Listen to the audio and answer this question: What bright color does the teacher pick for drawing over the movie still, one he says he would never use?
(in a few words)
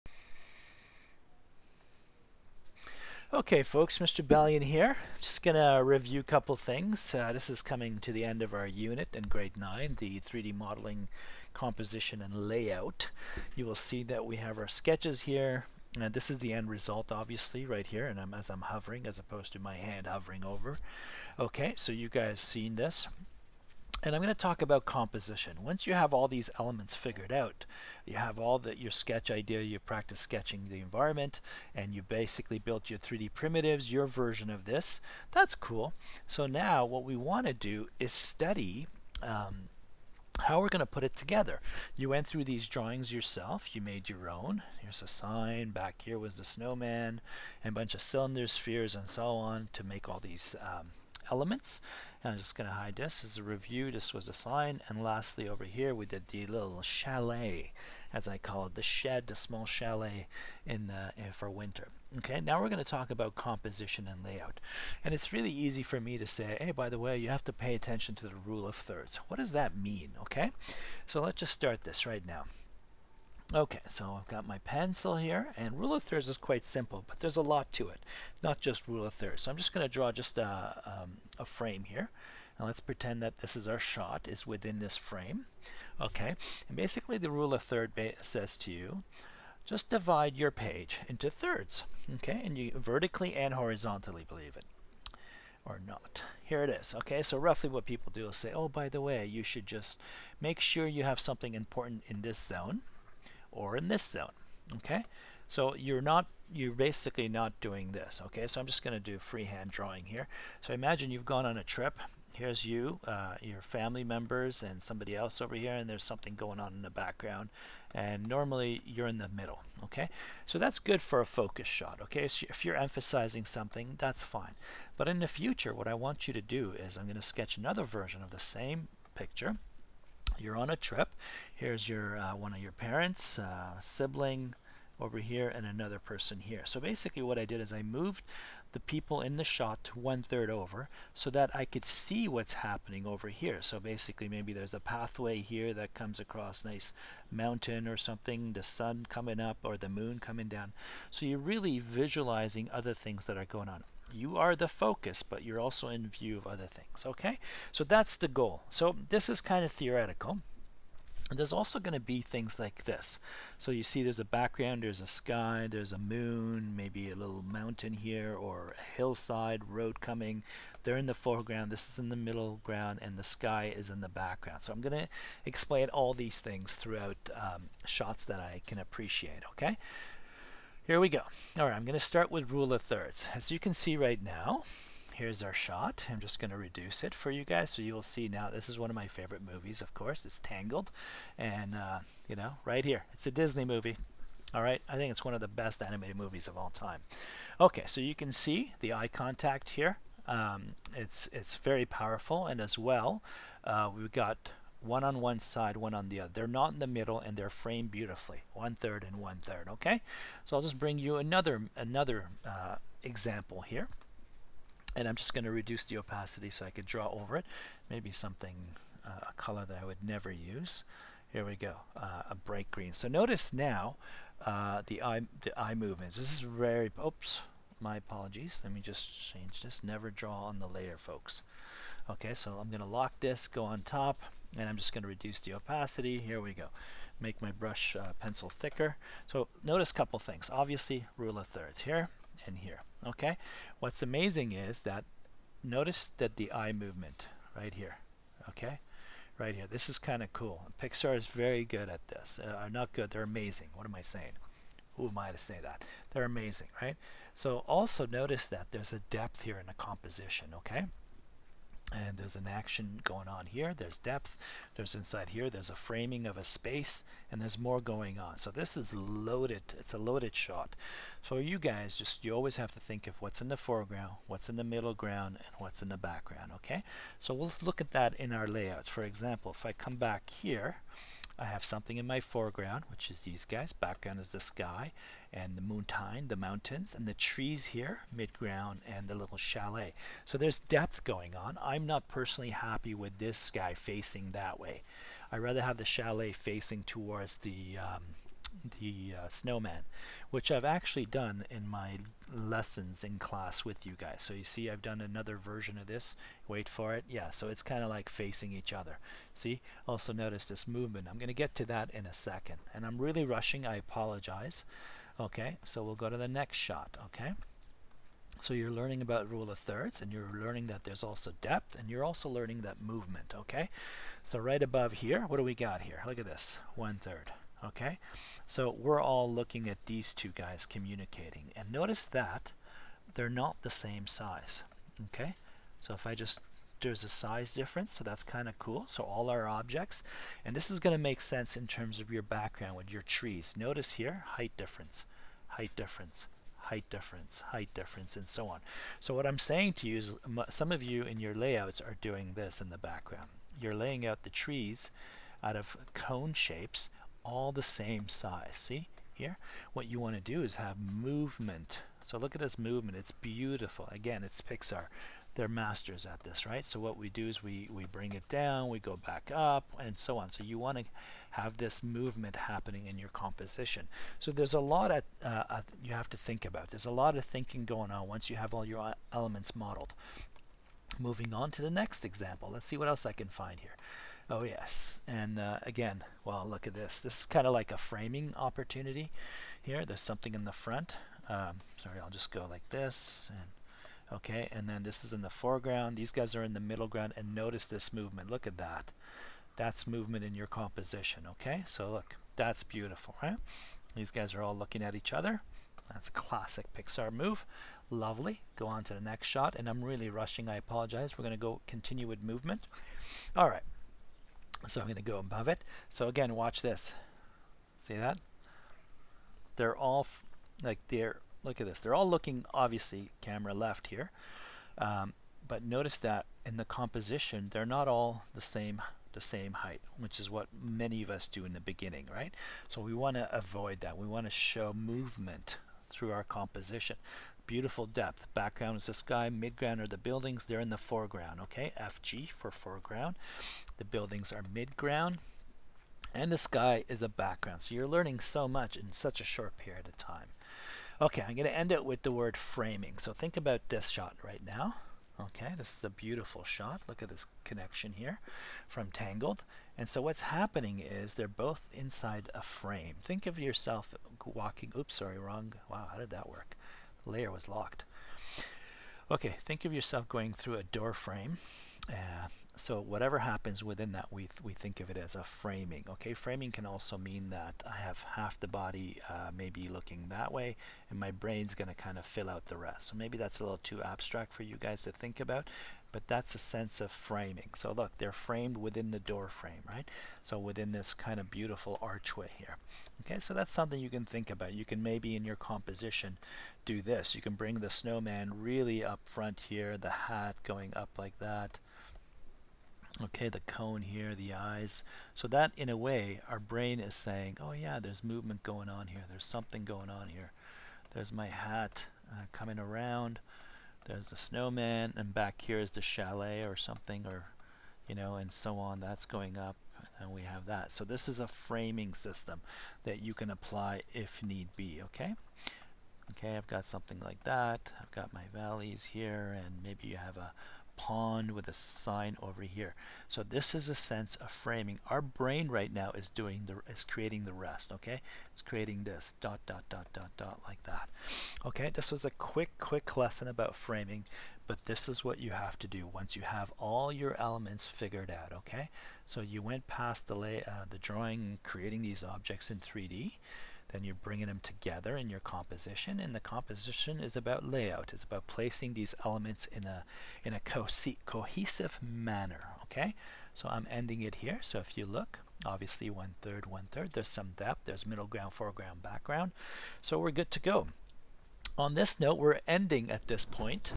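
Bright green.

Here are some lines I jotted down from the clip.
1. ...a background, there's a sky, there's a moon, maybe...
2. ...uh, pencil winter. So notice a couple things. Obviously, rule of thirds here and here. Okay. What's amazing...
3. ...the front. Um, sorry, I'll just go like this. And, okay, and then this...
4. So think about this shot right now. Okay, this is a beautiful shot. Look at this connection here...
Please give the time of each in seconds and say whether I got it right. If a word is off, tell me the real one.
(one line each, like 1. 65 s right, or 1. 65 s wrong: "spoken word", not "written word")
1. 164 s right
2. 237 s wrong: "thicker", not "winter"
3. 390 s right
4. 452 s right.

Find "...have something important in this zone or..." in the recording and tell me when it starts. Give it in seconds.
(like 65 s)
101 s.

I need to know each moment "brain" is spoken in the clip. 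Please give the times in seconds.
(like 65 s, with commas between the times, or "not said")
481 s, 506 s, 535 s.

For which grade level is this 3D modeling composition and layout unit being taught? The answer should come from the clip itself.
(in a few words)
Grade 9.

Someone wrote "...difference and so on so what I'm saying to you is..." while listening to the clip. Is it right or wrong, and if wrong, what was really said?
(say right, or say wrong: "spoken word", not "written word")
right.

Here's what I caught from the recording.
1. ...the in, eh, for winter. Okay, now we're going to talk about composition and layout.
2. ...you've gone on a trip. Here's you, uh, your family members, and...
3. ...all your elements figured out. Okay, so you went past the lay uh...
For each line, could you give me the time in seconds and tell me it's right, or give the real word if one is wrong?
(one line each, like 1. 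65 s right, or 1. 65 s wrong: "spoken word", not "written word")
1. 60 s right
2. 111 s right
3. 546 s right.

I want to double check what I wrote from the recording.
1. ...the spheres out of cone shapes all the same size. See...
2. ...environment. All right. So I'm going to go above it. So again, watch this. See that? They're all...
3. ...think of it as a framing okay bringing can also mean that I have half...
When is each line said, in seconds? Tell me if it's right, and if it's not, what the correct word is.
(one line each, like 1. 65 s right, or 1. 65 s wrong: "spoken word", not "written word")
1. 354 s wrong: "trees", not "spheres"
2. 412 s wrong: "movement", not "environment"
3. 474 s wrong: "framing", not "bringing".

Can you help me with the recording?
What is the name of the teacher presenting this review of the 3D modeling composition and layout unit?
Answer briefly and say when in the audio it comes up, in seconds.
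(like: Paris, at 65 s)
Mr. Balian, at 3 s.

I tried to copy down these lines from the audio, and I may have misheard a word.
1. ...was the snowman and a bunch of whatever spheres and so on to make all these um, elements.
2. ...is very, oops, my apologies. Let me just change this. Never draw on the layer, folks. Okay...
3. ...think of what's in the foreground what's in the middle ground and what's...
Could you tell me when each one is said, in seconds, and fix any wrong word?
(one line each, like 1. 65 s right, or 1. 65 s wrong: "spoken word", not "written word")
1. 46 s wrong: "cylinder", not "whatever"
2. 226 s right
3. 272 s right.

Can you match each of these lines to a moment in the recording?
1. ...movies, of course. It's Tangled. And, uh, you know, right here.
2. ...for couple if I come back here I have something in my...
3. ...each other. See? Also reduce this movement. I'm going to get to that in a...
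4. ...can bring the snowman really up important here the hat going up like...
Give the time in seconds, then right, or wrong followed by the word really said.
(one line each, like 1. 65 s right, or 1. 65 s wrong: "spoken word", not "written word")
1. 189 s right
2. 278 s wrong: "example", not "couple"
3. 308 s wrong: "notice", not "reduce"
4. 497 s wrong: "front", not "important".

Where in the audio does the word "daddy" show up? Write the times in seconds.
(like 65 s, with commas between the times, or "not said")
not said.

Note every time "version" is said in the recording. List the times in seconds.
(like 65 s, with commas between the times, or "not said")
34 s, 127 s, 305 s.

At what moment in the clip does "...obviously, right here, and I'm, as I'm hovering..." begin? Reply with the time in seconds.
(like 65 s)
17 s.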